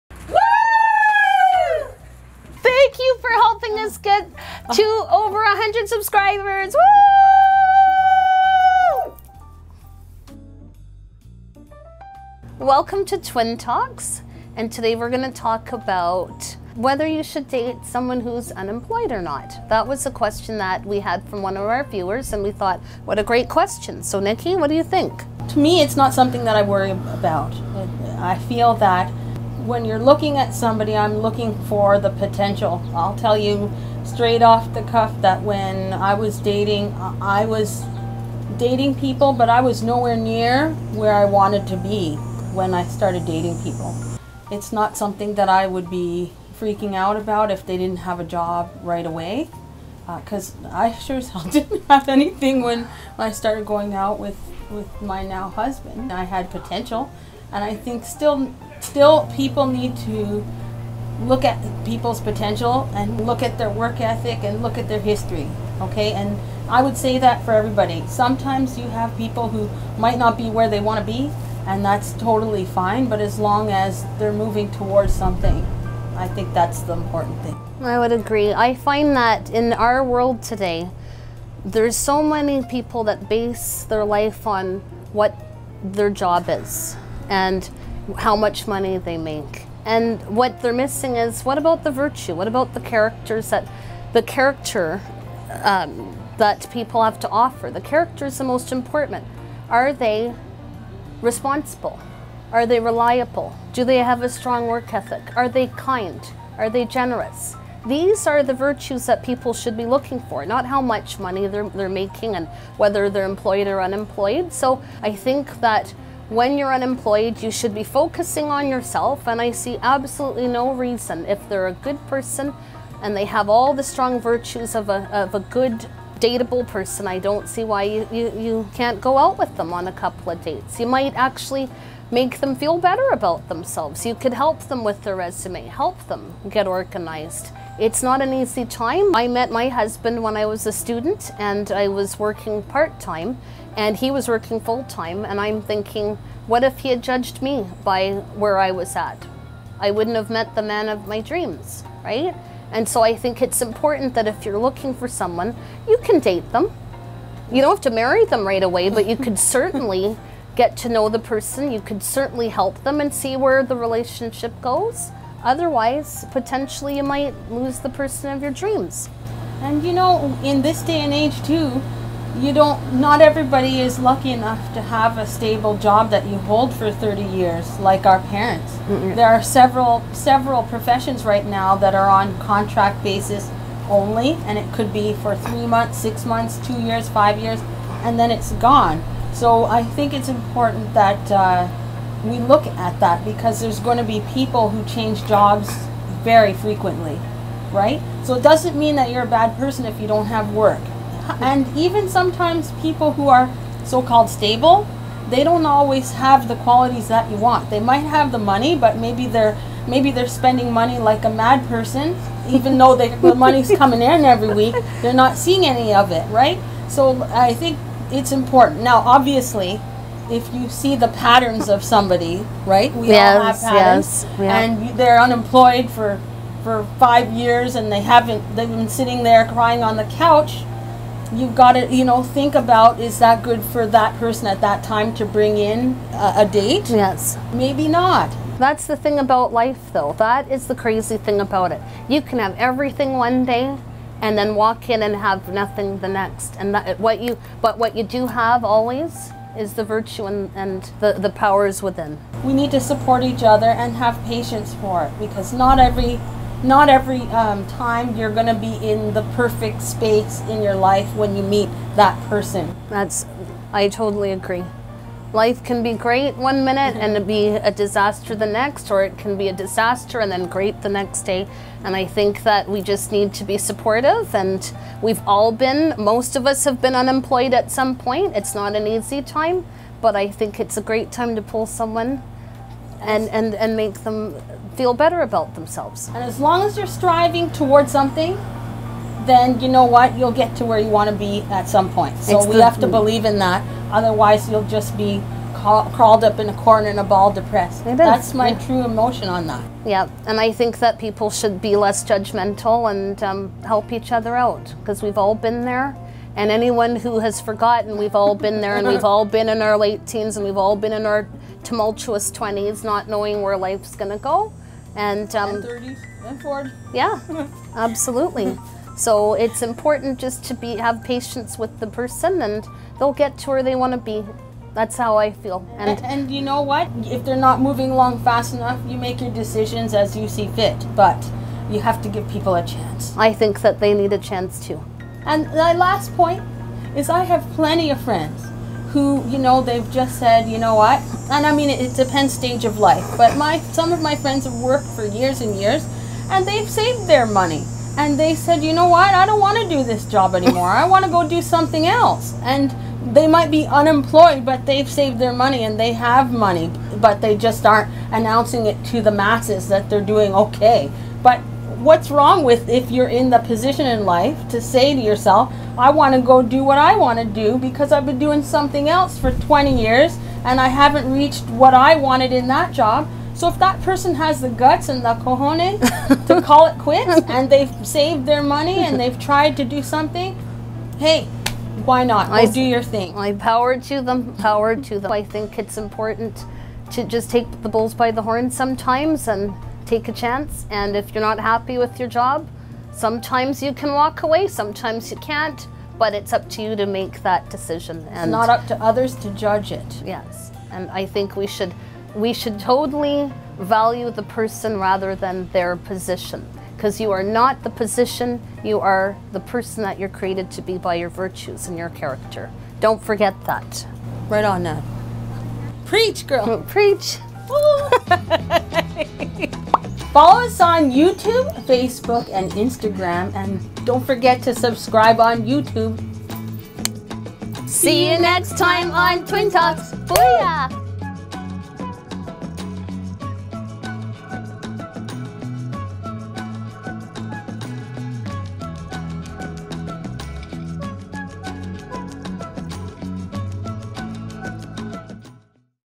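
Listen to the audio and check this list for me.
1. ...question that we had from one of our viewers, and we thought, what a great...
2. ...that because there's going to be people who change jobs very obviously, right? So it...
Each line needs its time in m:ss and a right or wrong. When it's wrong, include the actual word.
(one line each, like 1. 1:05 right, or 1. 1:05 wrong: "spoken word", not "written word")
1. 0:20 right
2. 3:12 wrong: "frequently", not "obviously".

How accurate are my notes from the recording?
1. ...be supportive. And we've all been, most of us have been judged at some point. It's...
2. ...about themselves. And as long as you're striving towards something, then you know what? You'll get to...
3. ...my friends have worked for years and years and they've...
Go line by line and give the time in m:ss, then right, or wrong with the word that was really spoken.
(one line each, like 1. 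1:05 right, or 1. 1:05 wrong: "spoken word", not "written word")
1. 4:33 wrong: "unemployed", not "judged"
2. 4:45 right
3. 5:44 right.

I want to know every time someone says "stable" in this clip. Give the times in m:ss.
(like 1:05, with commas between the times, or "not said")
2:55, 3:24.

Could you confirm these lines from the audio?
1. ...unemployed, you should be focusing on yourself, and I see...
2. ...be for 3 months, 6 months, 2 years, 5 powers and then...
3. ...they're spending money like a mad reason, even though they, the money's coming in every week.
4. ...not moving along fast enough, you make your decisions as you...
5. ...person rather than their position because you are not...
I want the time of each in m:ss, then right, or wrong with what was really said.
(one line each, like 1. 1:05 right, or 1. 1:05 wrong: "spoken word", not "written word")
1. 1:56 right
2. 3:04 wrong: "years", not "powers"
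3. 3:30 wrong: "person", not "reason"
4. 5:27 right
5. 6:44 right.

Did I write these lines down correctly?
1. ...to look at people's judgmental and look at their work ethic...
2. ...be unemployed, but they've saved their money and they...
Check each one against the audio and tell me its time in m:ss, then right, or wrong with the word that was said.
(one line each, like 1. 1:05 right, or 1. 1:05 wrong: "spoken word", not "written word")
1. 0:59 wrong: "potential", not "judgmental"
2. 5:53 right.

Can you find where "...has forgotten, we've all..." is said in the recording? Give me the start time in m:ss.
5:07.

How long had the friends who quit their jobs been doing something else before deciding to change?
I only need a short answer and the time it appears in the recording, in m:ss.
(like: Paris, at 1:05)
20 years, at 6:09.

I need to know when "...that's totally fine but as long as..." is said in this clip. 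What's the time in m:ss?
1:11.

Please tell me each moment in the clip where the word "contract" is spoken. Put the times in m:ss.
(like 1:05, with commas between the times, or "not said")
3:02.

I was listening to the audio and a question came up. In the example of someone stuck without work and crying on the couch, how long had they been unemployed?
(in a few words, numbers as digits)
5 years.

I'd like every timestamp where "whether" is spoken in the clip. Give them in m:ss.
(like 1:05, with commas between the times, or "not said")
0:16, 1:52.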